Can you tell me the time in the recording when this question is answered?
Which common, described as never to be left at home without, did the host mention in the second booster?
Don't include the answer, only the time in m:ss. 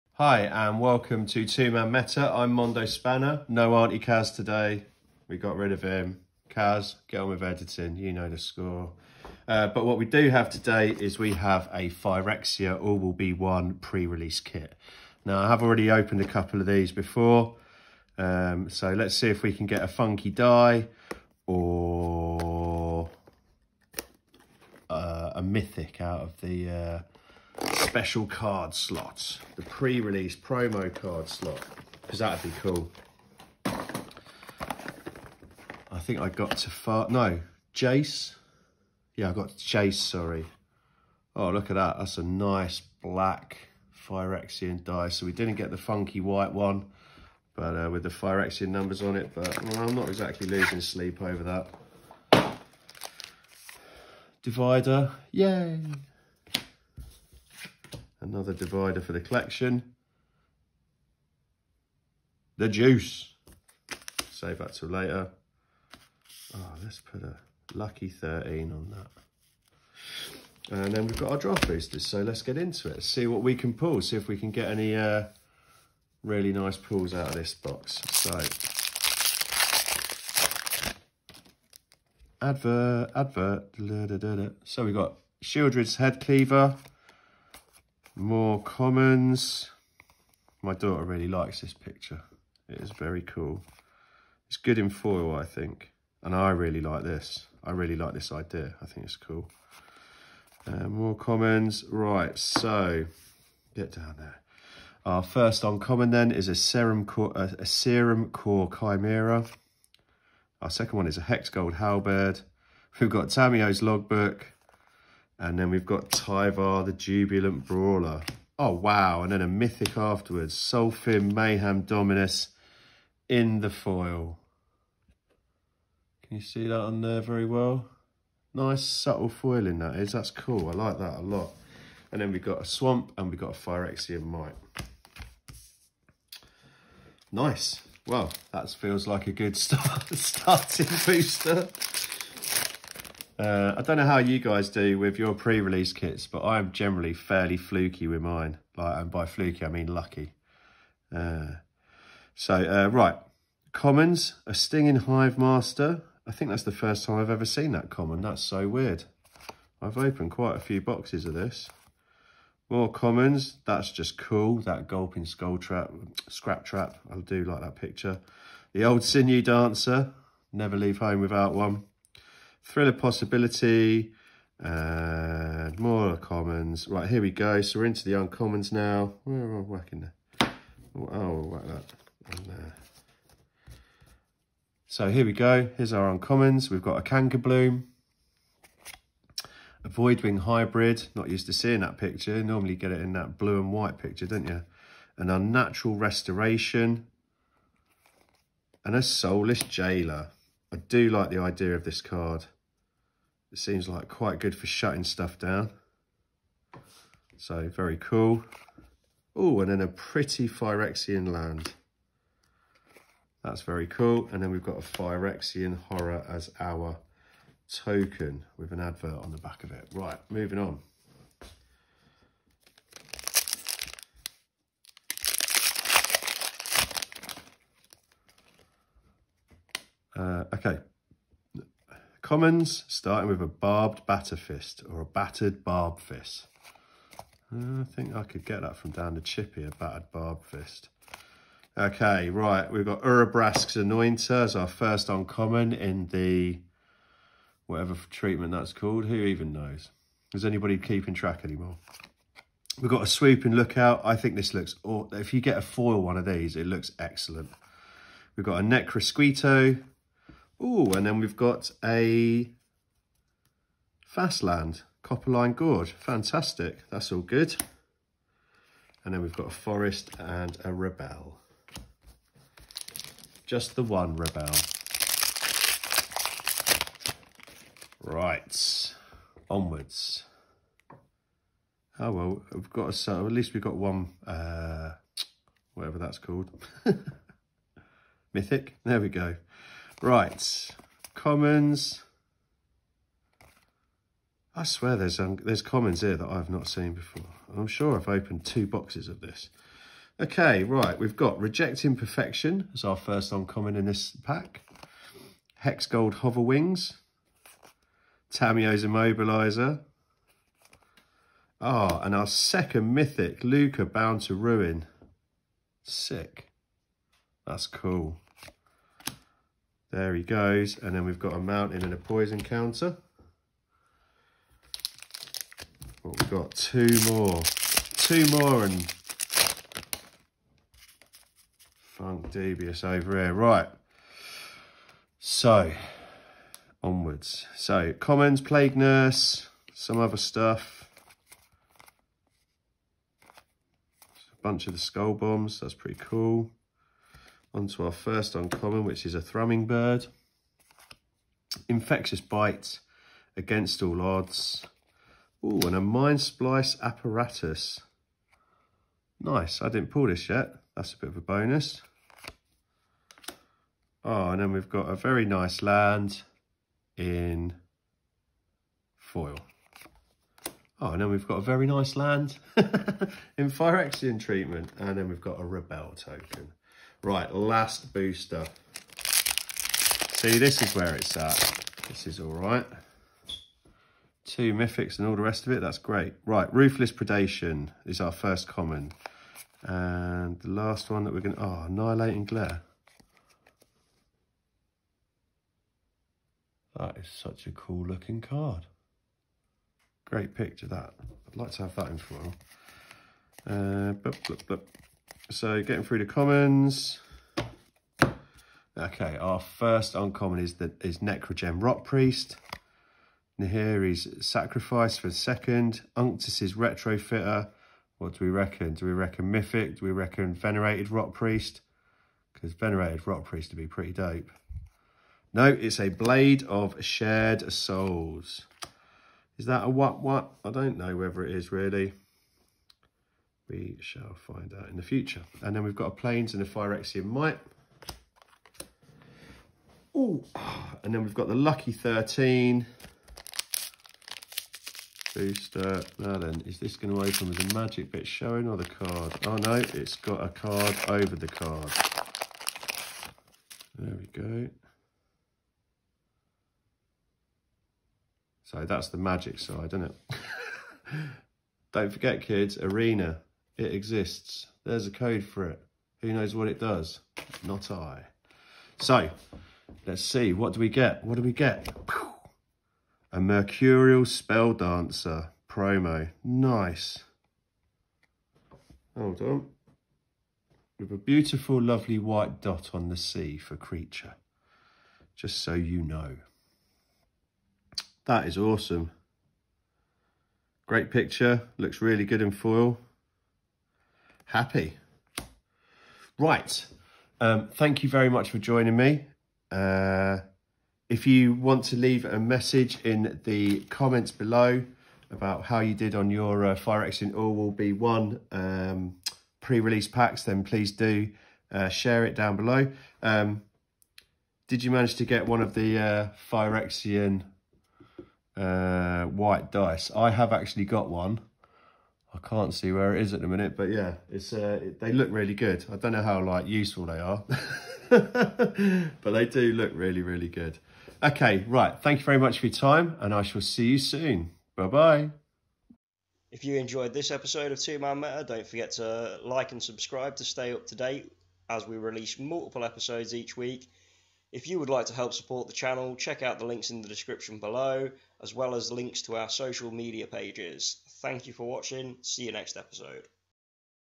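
2:49.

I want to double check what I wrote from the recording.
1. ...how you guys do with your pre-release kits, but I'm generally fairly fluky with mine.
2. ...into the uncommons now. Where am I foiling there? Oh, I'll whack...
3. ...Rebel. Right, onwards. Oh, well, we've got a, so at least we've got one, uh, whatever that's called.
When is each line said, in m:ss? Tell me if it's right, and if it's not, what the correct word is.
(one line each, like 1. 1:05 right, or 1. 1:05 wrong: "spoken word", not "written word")
1. 2:24 right
2. 2:57 wrong: "whacking", not "foiling"
3. 4:34 right.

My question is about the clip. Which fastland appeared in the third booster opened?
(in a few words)
Copperline Gorge.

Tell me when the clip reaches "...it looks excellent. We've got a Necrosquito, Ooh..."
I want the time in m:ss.
4:16.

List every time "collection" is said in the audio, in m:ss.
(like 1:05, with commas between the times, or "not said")
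0:59.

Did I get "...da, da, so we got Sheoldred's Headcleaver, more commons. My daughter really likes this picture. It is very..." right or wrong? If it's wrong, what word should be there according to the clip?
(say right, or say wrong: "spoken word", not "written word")
right.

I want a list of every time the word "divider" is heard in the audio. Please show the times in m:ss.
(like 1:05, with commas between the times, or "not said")
0:54, 0:58.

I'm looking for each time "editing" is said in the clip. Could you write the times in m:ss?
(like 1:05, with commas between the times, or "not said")
0:07.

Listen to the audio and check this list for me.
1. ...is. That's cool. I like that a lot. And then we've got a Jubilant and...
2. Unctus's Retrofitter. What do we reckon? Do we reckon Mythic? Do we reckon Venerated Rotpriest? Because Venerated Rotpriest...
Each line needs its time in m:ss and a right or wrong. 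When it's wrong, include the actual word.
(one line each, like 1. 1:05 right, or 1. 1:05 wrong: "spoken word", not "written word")
1. 2:09 wrong: "Swamp", not "Jubilant"
2. 6:55 right.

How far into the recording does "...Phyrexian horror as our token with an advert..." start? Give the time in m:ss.
3:34.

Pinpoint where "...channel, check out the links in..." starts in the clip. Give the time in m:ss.
9:05.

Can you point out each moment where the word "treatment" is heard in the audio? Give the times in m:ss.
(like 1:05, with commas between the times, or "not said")
4:08, 6:14.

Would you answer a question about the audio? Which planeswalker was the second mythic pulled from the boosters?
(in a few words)
Lukka, Bound to Ruin.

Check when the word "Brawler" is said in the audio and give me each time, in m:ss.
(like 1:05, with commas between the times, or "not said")
1:57.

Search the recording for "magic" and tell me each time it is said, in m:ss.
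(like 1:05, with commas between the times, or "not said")
7:27, 7:38.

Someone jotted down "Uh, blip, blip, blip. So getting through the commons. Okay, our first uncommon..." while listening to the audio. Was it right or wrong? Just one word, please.
right.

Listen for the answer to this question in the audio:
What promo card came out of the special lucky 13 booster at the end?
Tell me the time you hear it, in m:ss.
7:53.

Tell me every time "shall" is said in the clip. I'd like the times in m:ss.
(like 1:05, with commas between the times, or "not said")
7:13, 8:53.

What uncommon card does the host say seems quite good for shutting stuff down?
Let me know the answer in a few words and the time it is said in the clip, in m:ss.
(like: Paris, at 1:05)
Soulless Jailer, at 3:19.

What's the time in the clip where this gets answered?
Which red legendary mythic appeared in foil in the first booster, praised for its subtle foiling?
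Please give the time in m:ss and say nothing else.
2:00.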